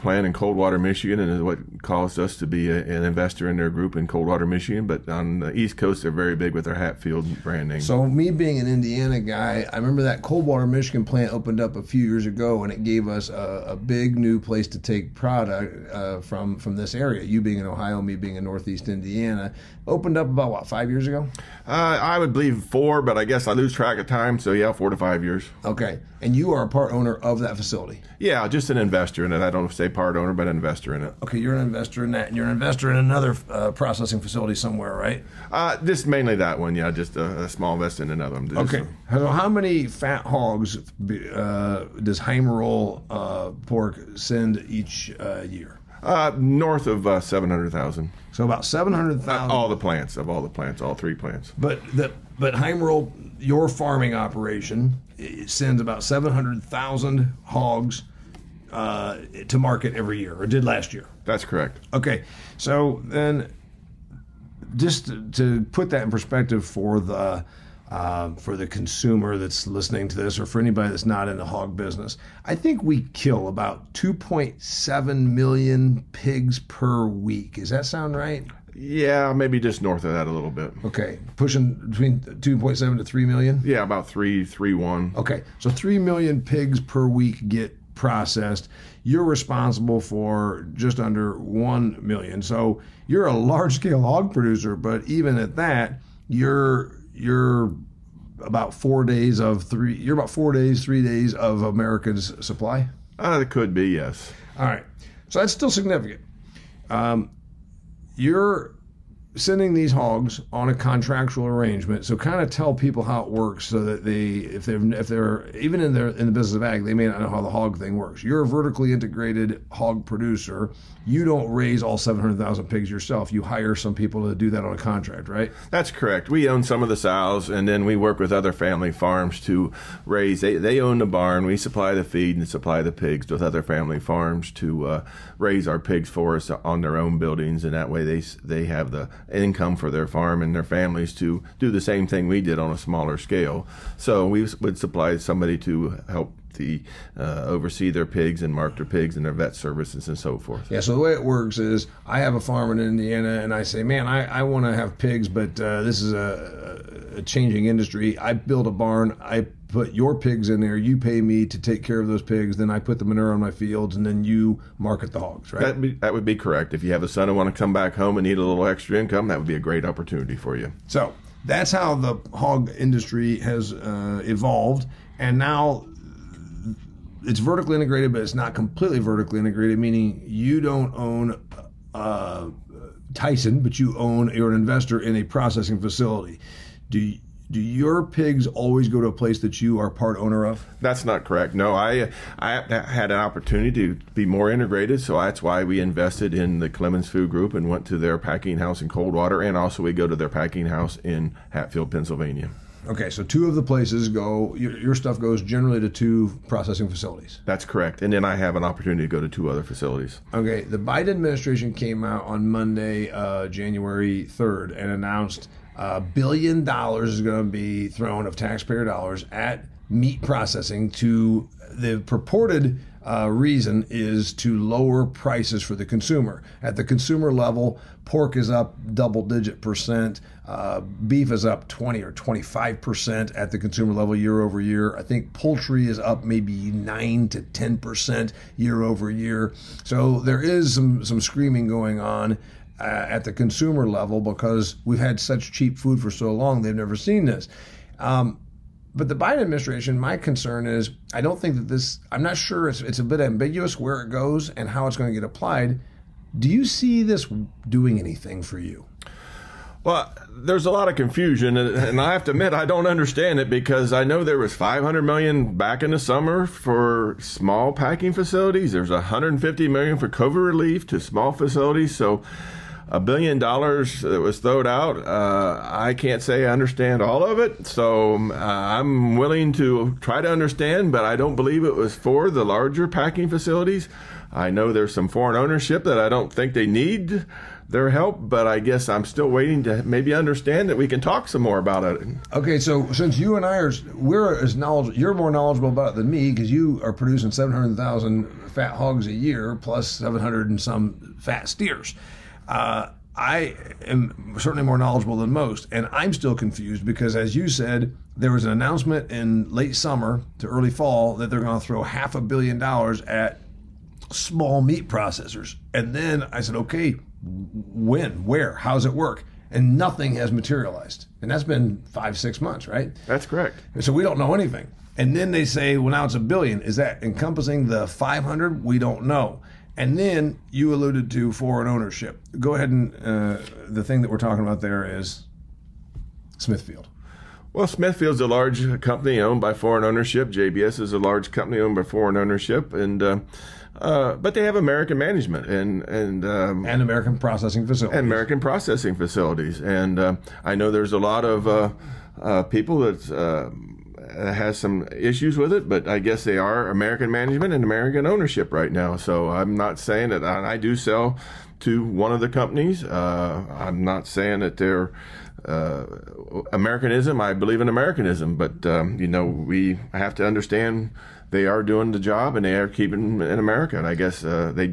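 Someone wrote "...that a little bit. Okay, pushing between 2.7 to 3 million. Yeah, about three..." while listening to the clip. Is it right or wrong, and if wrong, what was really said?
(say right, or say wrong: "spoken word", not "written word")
right.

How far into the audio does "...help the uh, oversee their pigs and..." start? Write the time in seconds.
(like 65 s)
146 s.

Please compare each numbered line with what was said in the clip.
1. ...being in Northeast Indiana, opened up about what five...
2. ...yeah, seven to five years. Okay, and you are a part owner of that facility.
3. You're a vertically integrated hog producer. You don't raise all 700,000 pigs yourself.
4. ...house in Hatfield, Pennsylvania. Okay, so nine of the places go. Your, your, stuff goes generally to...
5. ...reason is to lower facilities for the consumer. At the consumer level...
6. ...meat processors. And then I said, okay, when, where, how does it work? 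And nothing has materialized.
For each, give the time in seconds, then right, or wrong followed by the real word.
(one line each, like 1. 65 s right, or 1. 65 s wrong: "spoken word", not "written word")
1. 18 s right
2. 24 s wrong: "four", not "seven"
3. 118 s right
4. 200 s wrong: "two", not "nine"
5. 223 s wrong: "prices", not "facilities"
6. 314 s right.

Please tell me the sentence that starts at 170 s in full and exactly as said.
So that's how the hog industry has uh, evolved, and now it's vertically integrated, but it's not completely vertically integrated.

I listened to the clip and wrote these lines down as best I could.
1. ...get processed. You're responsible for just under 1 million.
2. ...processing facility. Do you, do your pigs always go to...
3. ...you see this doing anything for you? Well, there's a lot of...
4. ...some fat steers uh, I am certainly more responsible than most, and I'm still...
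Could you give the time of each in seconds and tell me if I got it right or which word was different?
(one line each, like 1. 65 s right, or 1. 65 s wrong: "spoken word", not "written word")
1. 87 s right
2. 185 s right
3. 256 s right
4. 300 s wrong: "knowledgeable", not "responsible".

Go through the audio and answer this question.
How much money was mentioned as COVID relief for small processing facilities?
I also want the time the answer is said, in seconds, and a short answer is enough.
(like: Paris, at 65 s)
150 million, at 268 s.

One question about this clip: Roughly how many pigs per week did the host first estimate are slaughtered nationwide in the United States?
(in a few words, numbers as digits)
2.7 million.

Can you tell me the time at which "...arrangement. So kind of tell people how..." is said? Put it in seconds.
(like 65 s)
111 s.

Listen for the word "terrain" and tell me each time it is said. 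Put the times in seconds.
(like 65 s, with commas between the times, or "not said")
not said.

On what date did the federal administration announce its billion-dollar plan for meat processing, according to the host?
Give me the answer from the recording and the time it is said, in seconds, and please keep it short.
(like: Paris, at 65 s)
January 3, at 213 s.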